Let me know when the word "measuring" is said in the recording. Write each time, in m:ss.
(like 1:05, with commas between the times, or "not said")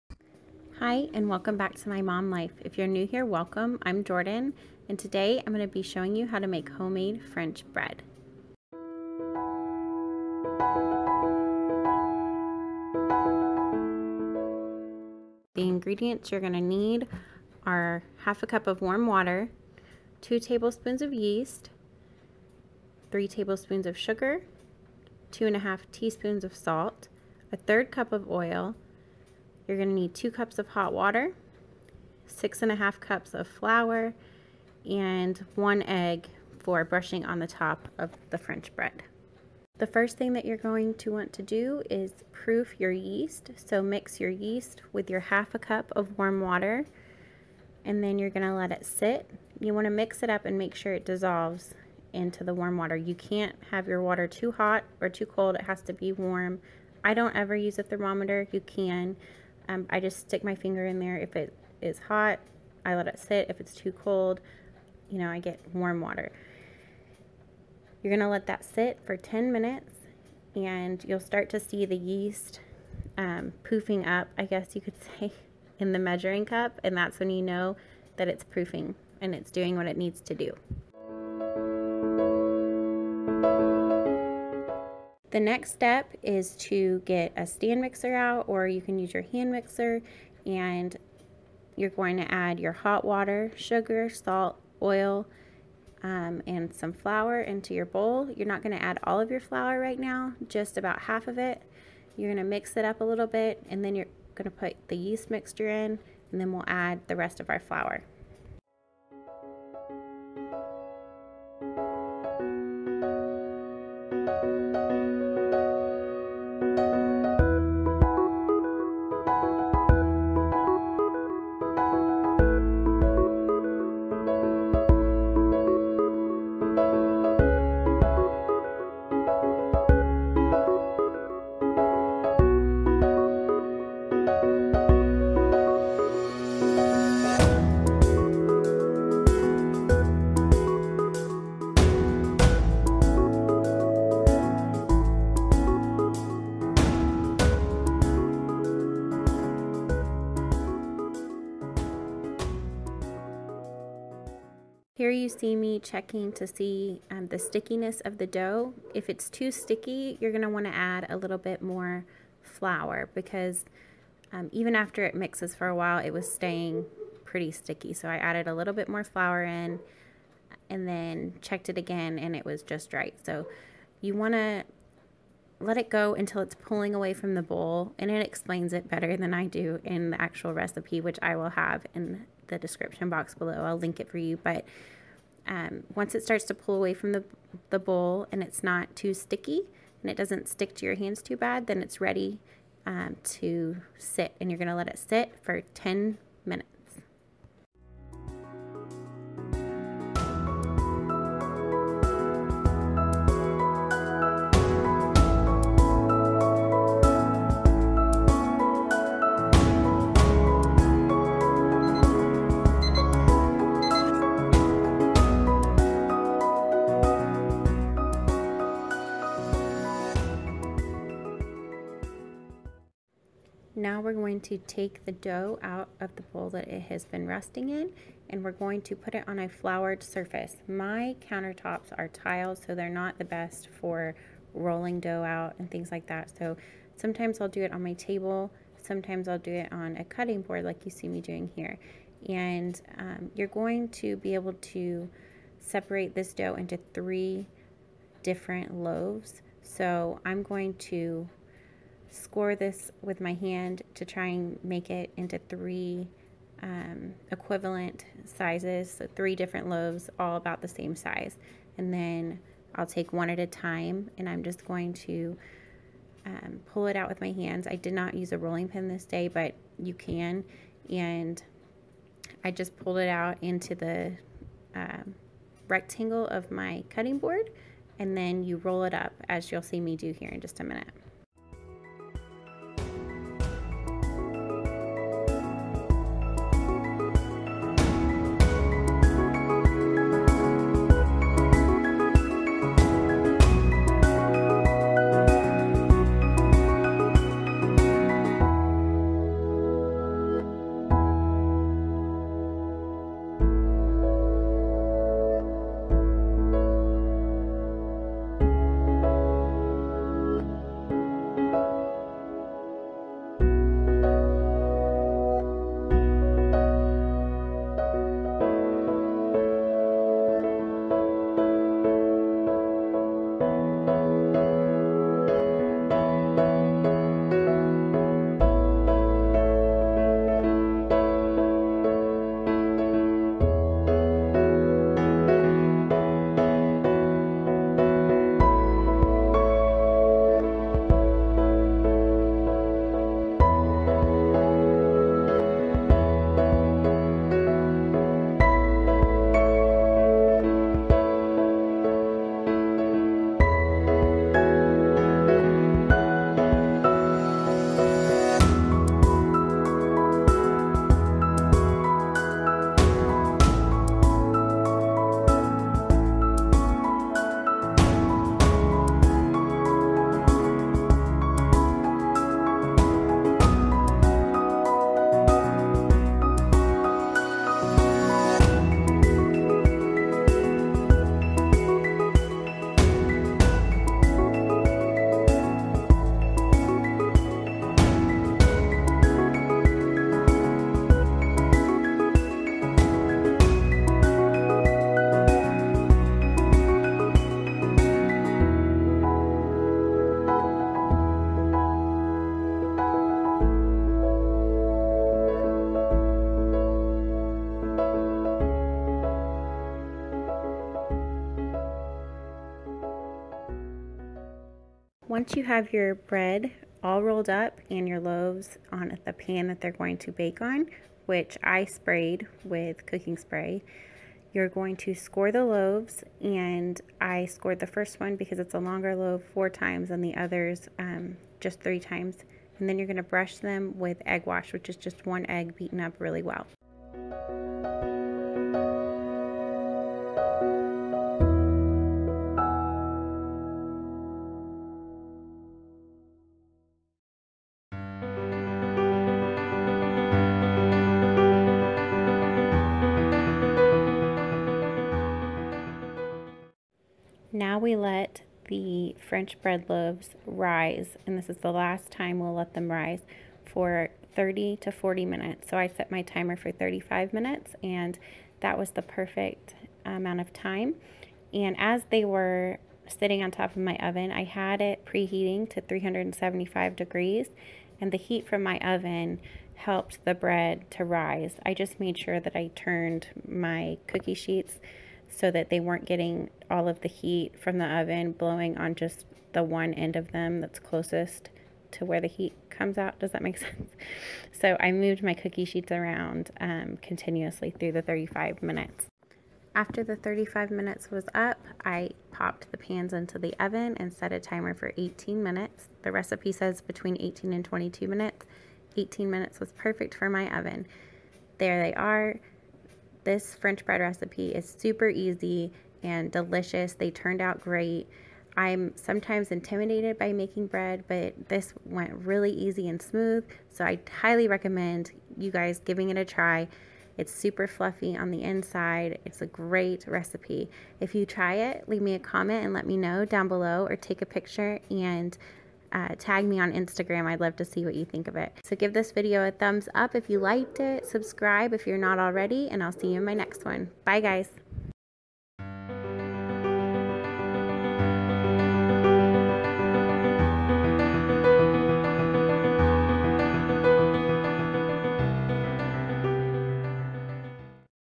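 1:15.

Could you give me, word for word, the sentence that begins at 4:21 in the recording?
And then I'll take one at a time and I'm just going to um, pull it out with my hands.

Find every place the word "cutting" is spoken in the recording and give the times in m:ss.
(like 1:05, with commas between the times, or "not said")
4:00, 4:36.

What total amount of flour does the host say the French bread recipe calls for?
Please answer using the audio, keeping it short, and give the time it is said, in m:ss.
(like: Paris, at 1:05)
6 1/2 cups, at 0:32.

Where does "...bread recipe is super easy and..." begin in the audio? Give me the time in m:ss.
8:33.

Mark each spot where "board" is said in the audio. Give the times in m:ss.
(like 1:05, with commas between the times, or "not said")
4:00, 4:37.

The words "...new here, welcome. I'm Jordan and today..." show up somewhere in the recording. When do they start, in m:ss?
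0:02.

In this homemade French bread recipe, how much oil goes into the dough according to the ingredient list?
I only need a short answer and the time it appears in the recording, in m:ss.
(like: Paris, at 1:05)
1/3 cup, at 0:27.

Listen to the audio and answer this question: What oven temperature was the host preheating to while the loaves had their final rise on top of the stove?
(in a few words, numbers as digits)
375 degrees.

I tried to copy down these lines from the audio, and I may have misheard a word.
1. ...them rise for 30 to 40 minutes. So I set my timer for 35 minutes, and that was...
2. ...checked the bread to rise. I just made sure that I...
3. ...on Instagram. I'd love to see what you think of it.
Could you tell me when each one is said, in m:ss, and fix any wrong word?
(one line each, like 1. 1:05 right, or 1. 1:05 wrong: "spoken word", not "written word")
1. 7:42 right
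2. 7:59 wrong: "helped", not "checked"
3. 8:56 right.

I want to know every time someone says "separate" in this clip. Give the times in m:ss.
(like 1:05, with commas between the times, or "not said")
4:05.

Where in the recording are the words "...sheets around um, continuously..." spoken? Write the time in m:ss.
8:15.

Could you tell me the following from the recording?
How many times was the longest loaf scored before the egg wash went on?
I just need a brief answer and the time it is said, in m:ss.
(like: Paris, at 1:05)
4, at 7:09.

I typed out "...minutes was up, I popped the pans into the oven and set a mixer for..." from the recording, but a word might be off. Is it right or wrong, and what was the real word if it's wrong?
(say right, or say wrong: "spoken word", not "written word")
wrong: "timer", not "mixer".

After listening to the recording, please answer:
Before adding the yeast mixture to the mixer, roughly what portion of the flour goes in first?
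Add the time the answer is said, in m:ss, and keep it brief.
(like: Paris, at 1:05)
About half, at 1:40.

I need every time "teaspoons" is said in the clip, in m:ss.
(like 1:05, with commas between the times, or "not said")
0:25.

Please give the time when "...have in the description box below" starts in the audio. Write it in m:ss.
3:01.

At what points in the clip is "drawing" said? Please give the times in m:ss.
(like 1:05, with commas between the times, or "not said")
not said.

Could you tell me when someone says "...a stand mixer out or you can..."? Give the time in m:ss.
1:27.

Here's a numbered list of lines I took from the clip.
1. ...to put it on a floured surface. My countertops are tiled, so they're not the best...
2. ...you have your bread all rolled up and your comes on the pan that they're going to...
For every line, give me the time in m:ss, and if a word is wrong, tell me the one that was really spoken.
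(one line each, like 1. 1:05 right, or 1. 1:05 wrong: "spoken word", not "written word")
1. 3:48 right
2. 6:55 wrong: "loaves", not "comes".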